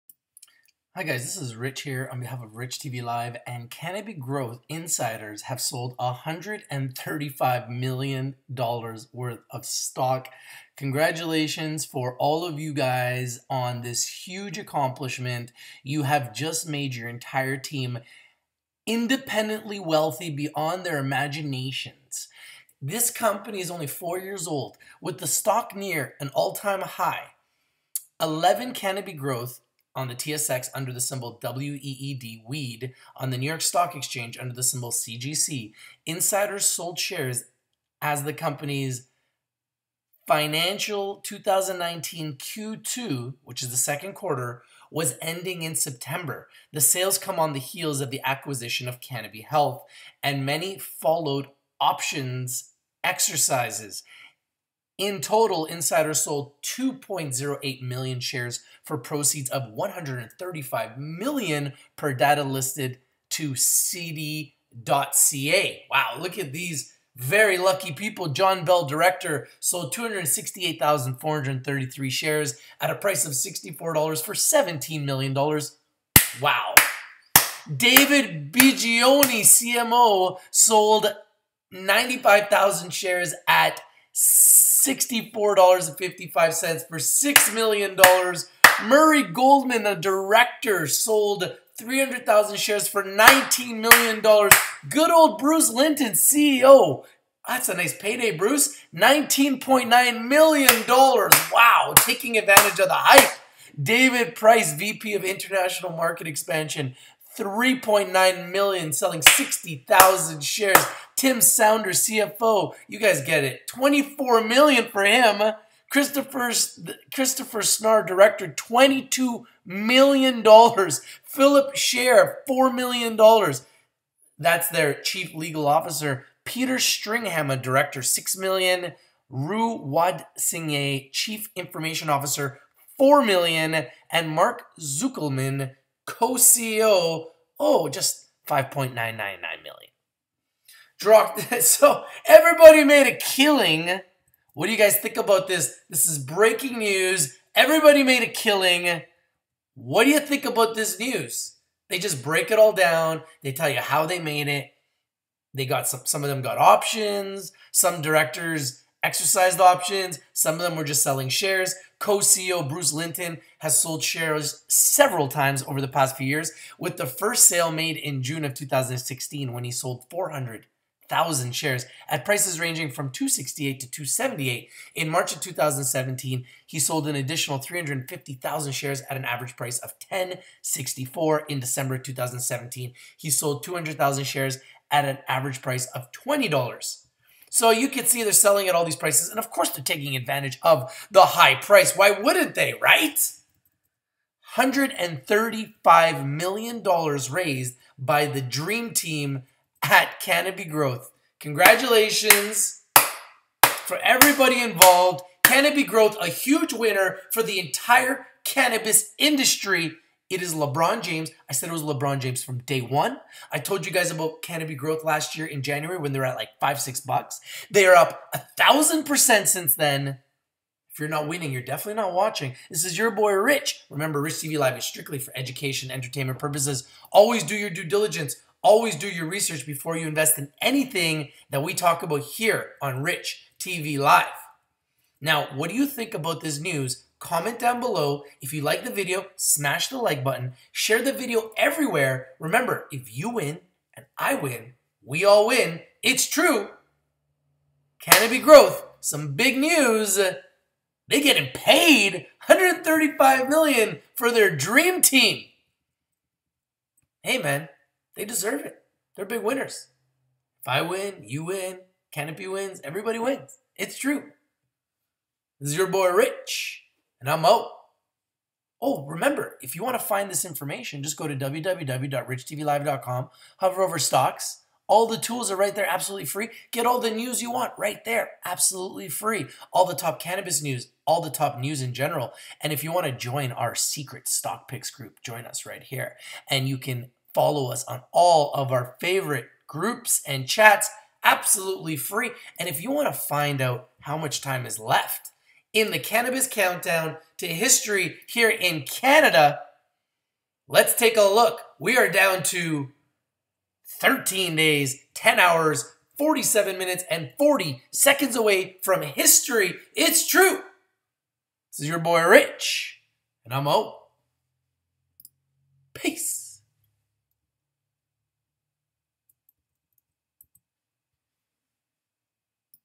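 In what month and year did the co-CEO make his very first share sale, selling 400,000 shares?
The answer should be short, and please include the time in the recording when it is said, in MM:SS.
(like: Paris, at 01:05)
June 2016, at 02:48.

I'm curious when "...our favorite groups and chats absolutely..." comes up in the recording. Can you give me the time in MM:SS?
04:48.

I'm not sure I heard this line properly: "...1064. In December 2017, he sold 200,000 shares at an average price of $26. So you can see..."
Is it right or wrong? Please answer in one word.
wrong.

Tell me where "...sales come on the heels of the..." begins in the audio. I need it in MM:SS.
00:46.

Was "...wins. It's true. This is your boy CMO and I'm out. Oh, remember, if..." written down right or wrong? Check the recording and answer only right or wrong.
wrong.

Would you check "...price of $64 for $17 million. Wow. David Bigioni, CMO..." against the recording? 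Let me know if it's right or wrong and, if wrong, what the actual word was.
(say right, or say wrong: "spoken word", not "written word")
right.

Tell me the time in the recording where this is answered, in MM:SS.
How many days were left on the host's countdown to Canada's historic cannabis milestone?
05:03.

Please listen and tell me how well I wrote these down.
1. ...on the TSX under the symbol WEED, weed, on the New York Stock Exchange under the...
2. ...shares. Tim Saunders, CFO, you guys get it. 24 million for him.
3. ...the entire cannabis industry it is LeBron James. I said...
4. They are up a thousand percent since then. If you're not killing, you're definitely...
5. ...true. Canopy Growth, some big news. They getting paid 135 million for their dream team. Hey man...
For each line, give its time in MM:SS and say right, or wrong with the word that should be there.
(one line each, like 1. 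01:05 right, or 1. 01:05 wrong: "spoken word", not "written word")
1. 00:29 right
2. 01:50 right
3. 03:27 right
4. 03:37 wrong: "winning", not "killing"
5. 04:06 right.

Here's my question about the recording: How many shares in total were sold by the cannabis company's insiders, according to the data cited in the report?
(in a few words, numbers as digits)
2.08 million.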